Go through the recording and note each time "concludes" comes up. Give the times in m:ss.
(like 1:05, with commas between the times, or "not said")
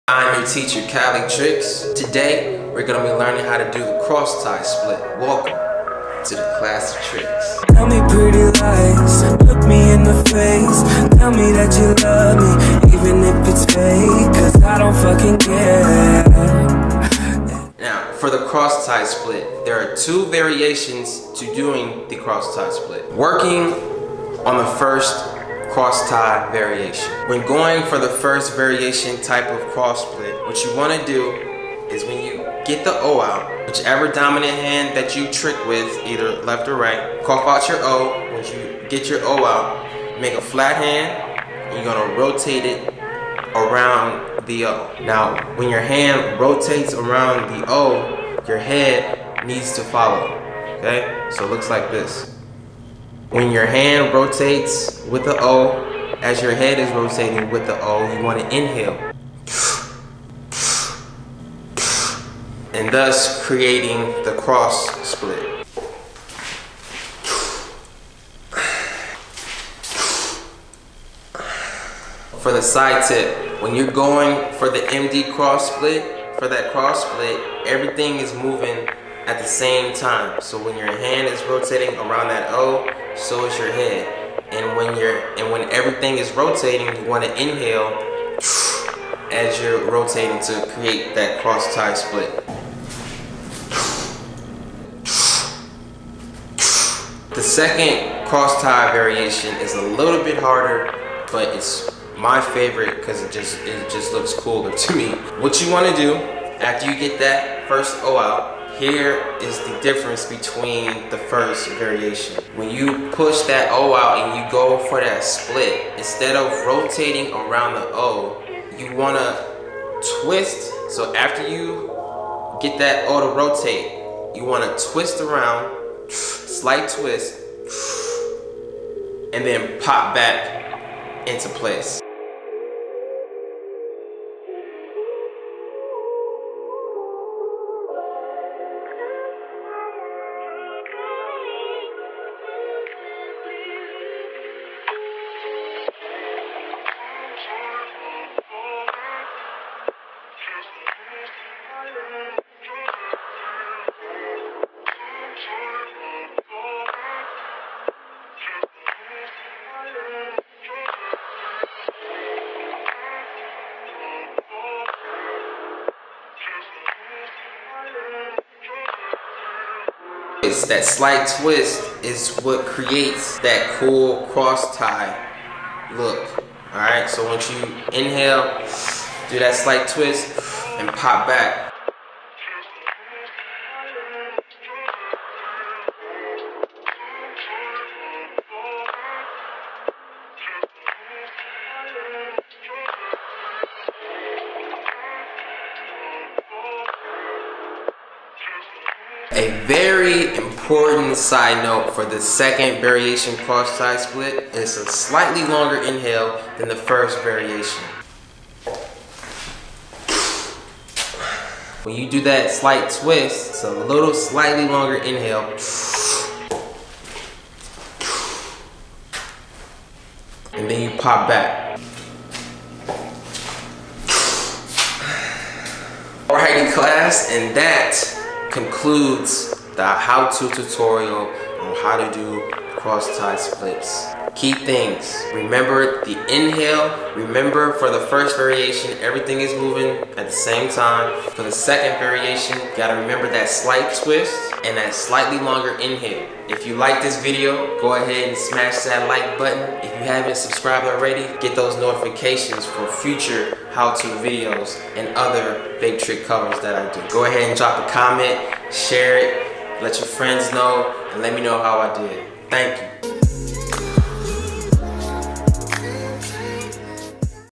3:48.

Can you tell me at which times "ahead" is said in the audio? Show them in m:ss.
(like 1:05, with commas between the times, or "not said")
4:07, 4:17.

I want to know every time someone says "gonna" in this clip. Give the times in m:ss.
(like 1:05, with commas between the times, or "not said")
0:02, 0:41.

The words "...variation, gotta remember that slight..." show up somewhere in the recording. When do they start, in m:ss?
4:01.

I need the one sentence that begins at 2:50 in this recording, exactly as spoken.
It's that slight twist is what creates that cool cross tie look.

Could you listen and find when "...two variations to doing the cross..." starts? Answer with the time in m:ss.
0:19.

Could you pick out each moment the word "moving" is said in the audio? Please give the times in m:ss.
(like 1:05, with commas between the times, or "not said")
1:18, 3:59.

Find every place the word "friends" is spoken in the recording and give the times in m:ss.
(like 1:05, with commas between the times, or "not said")
4:20.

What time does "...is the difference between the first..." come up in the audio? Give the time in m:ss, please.
1:49.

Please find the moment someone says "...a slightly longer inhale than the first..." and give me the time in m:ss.
3:24.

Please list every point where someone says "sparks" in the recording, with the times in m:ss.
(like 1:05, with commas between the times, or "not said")
not said.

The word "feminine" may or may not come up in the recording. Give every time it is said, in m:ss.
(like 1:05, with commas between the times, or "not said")
not said.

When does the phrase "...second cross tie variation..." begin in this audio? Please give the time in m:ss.
1:37.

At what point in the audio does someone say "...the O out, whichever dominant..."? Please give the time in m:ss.
0:32.